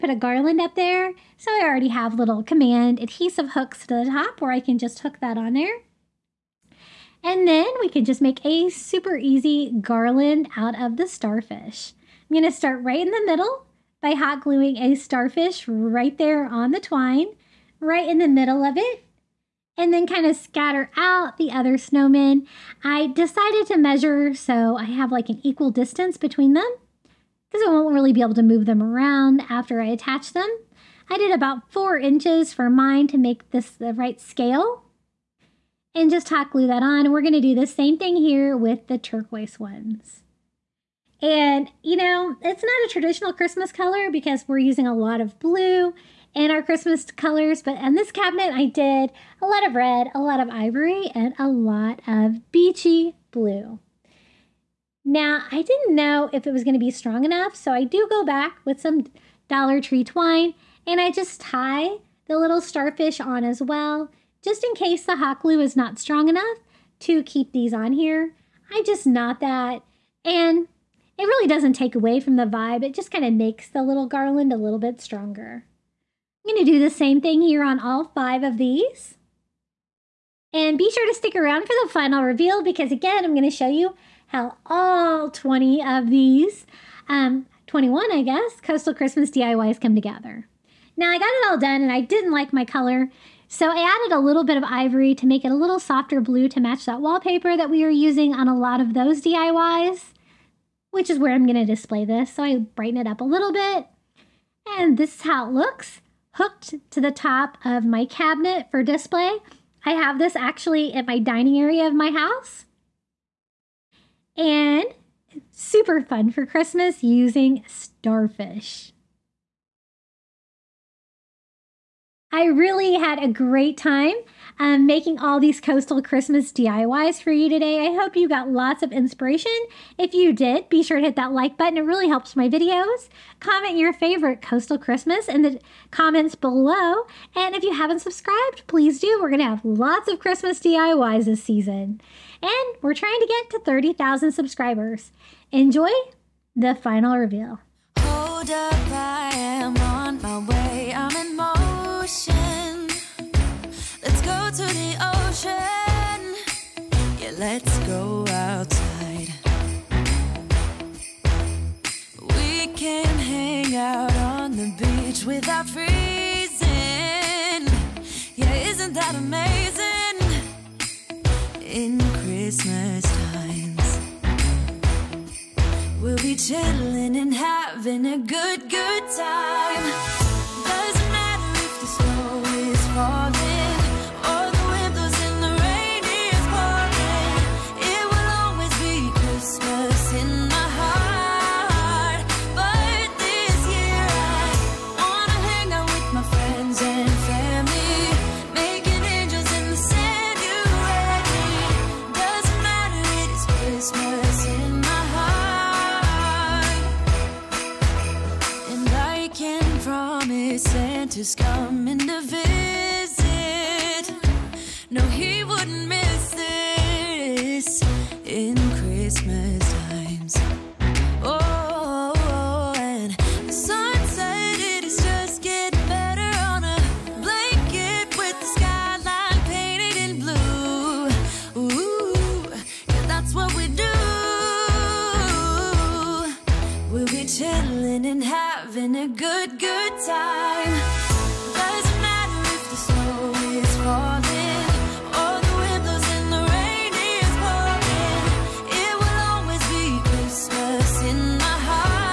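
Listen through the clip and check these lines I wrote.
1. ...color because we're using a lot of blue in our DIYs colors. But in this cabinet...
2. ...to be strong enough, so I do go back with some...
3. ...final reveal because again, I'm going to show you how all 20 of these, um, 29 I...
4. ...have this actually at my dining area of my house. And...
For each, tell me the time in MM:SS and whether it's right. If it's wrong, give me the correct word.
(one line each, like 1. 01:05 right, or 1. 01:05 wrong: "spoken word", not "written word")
1. 00:43 wrong: "Christmas", not "DIYs"
2. 00:56 right
3. 01:21 wrong: "21", not "29"
4. 01:49 right.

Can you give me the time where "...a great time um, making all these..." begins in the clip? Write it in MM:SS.
02:03.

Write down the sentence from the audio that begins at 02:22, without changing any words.
And we're trying to get to 30,000 subscribers.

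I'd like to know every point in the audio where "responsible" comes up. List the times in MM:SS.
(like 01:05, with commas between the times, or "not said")
not said.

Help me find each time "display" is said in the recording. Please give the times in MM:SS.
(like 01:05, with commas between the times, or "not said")
01:41, 01:48.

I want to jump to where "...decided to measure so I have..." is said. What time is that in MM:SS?
00:23.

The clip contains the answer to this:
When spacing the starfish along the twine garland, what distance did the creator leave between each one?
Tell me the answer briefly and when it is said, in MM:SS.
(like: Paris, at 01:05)
4 inches, at 00:31.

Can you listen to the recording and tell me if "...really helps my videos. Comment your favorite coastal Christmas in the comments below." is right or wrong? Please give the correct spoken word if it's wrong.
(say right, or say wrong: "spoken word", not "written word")
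right.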